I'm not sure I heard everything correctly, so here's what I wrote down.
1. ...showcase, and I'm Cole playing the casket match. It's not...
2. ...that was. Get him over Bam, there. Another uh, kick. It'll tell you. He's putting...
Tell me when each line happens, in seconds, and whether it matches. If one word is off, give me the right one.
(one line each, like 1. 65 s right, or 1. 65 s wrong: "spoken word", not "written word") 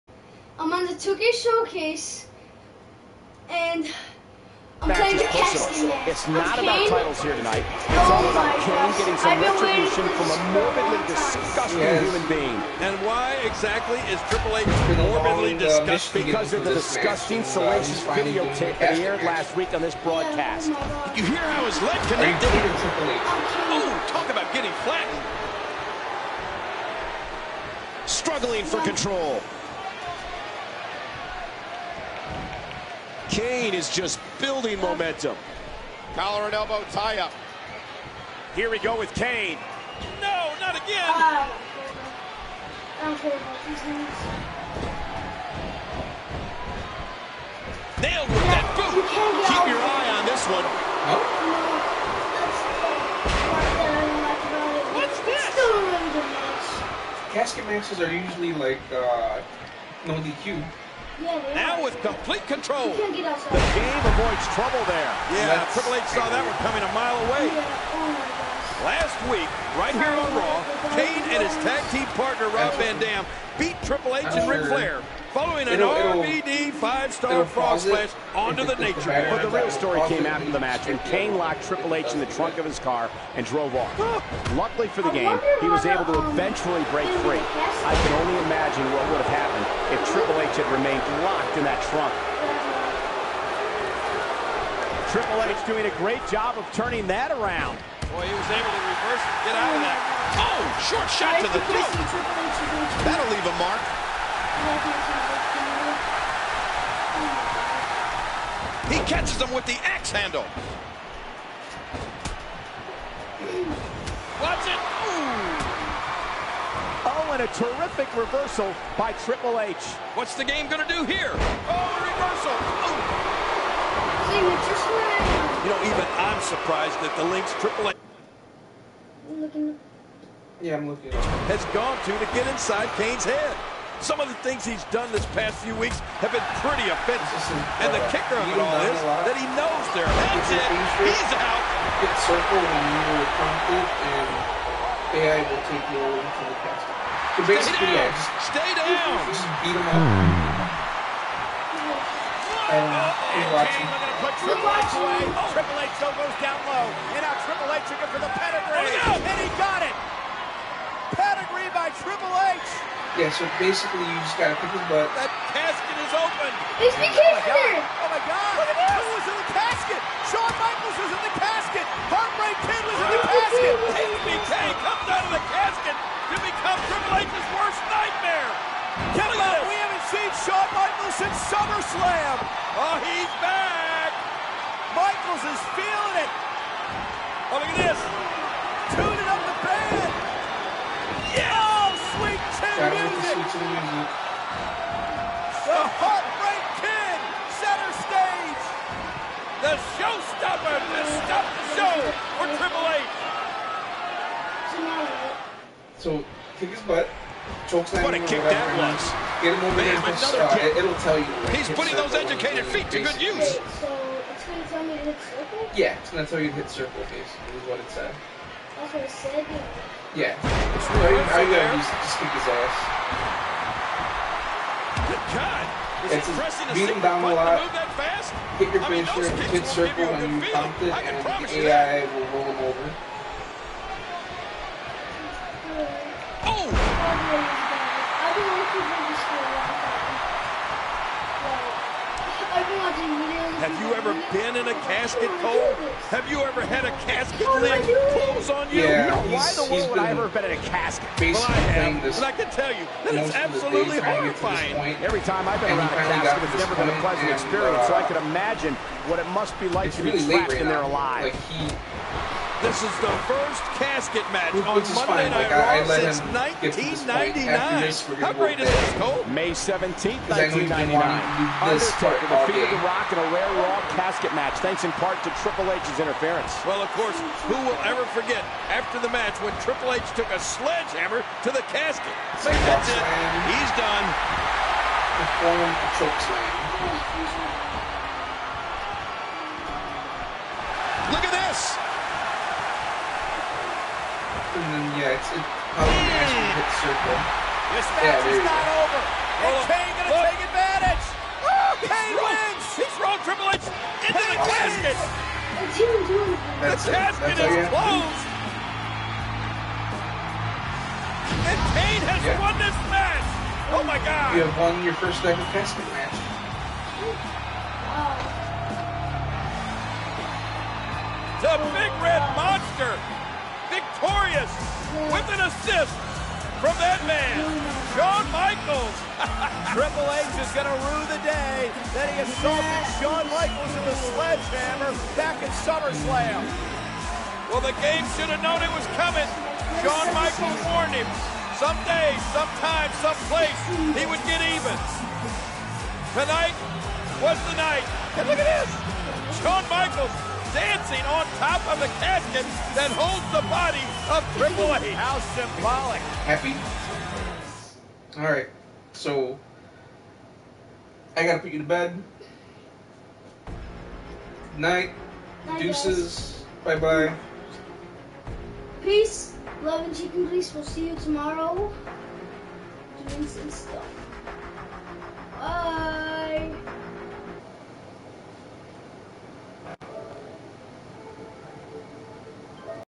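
1. 1 s wrong: "Back", not "Cole"
2. 208 s right.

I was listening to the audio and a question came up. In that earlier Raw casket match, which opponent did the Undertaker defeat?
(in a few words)
The Rock.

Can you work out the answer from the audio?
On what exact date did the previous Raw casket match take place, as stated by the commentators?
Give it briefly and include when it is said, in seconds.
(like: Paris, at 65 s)
May 17, 1999, at 269 s.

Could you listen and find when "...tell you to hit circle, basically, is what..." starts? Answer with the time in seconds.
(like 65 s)
216 s.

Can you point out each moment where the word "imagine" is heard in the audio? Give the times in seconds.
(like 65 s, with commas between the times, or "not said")
88 s, 258 s.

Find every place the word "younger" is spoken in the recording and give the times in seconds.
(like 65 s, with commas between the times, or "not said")
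not said.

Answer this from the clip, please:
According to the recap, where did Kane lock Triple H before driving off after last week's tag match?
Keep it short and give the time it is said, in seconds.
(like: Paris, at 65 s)
The trunk of his car, at 82 s.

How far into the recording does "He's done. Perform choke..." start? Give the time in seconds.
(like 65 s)
283 s.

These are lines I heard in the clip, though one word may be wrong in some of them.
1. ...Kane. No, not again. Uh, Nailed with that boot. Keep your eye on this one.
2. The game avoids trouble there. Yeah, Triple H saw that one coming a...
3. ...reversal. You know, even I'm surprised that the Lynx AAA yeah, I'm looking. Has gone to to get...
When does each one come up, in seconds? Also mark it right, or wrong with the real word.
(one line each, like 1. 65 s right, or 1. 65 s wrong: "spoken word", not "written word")
1. 39 s right
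2. 62 s right
3. 123 s right.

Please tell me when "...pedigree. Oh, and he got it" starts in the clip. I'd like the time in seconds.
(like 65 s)
158 s.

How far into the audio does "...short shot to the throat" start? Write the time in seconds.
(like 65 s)
100 s.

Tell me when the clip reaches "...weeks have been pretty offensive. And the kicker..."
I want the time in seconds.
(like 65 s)
135 s.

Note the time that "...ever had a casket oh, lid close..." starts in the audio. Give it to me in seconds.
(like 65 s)
246 s.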